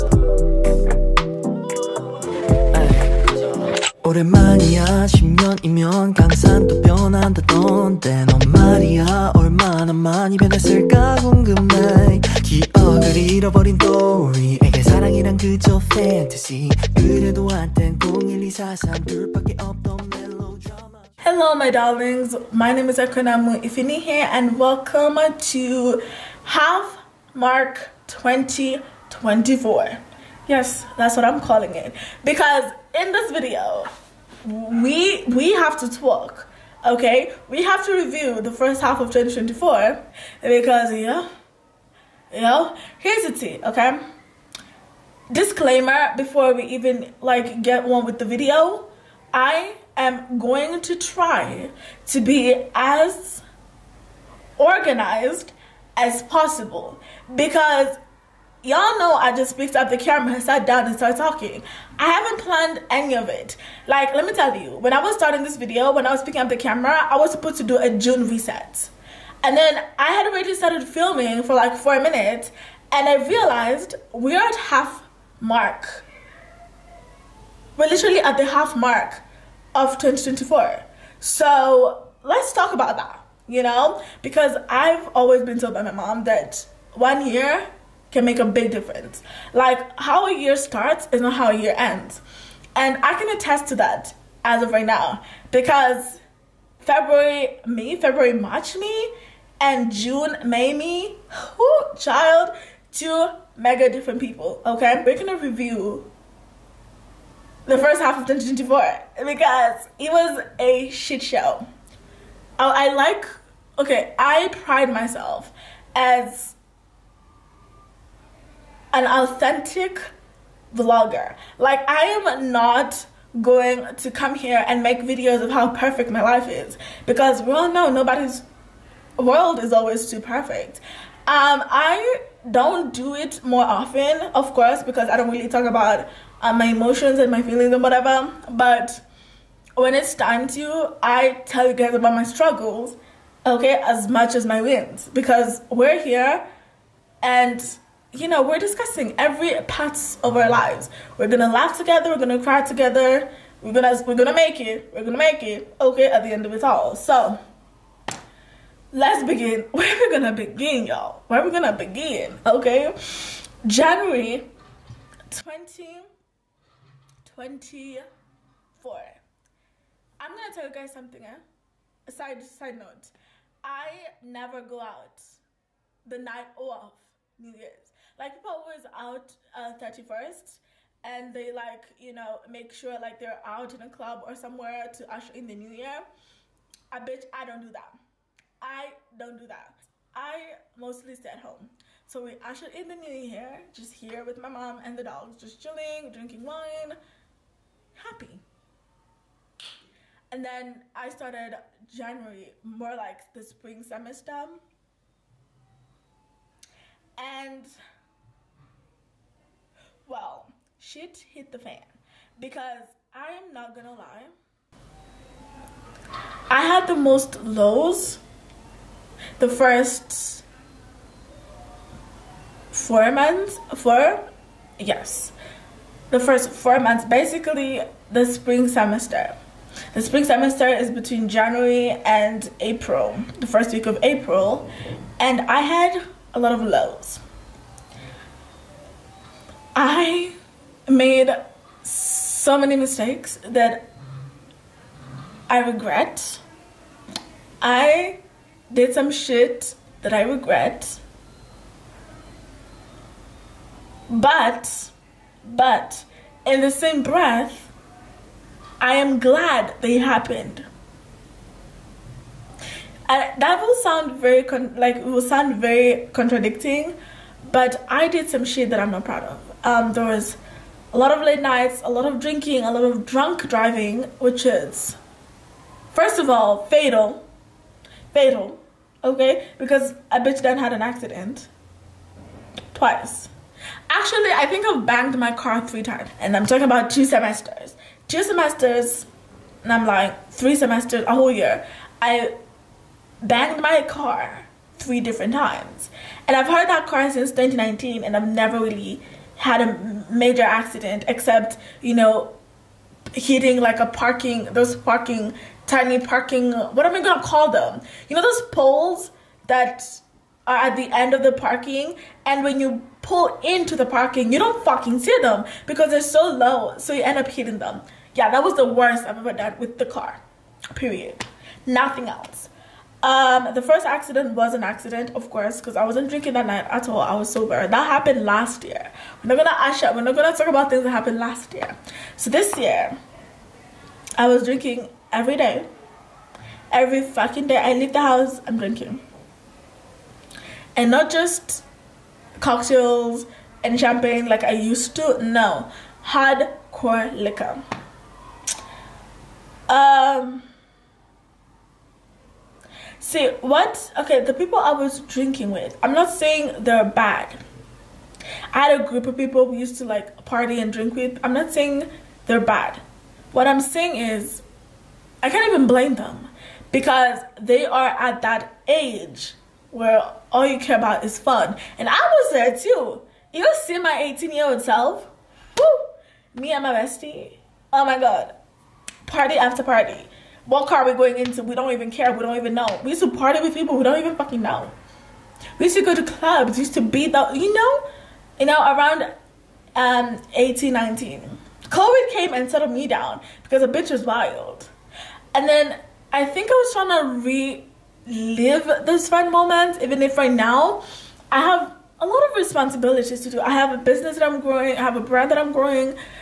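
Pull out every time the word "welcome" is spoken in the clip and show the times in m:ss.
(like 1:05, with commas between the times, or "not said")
0:24.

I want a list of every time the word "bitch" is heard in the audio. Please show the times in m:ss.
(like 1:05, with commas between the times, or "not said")
3:06, 4:40, 6:33.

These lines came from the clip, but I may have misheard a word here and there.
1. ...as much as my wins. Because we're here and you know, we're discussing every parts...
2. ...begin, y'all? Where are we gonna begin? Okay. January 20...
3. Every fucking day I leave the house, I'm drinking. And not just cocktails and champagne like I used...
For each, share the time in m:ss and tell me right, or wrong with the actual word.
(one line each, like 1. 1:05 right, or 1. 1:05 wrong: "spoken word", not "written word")
1. 2:23 right
2. 2:40 right
3. 5:36 right.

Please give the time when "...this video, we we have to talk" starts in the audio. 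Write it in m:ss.
0:33.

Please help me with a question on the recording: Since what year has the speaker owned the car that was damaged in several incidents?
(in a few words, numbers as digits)
2019.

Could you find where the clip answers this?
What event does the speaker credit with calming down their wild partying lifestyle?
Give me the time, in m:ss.
6:31.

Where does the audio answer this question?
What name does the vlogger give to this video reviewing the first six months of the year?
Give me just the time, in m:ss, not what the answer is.
0:26.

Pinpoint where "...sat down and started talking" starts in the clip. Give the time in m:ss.
1:00.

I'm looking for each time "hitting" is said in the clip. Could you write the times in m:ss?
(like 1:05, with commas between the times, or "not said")
5:03, 5:17.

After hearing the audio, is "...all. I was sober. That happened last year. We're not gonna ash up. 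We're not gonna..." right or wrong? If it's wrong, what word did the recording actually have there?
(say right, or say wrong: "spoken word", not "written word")
right.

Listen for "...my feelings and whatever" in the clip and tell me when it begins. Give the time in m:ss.
2:17.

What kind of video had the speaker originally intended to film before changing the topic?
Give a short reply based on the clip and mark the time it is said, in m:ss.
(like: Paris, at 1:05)
June reset, at 1:07.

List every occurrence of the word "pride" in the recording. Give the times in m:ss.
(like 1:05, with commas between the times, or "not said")
1:54.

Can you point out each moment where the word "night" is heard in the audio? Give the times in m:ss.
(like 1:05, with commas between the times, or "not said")
2:56, 4:31, 5:26.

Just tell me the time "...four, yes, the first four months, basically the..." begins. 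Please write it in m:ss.
3:43.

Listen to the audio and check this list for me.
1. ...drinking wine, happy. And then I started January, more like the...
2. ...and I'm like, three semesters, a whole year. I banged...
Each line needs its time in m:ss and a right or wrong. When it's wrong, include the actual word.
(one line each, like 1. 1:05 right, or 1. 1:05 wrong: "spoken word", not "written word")
1. 3:16 right
2. 4:49 right.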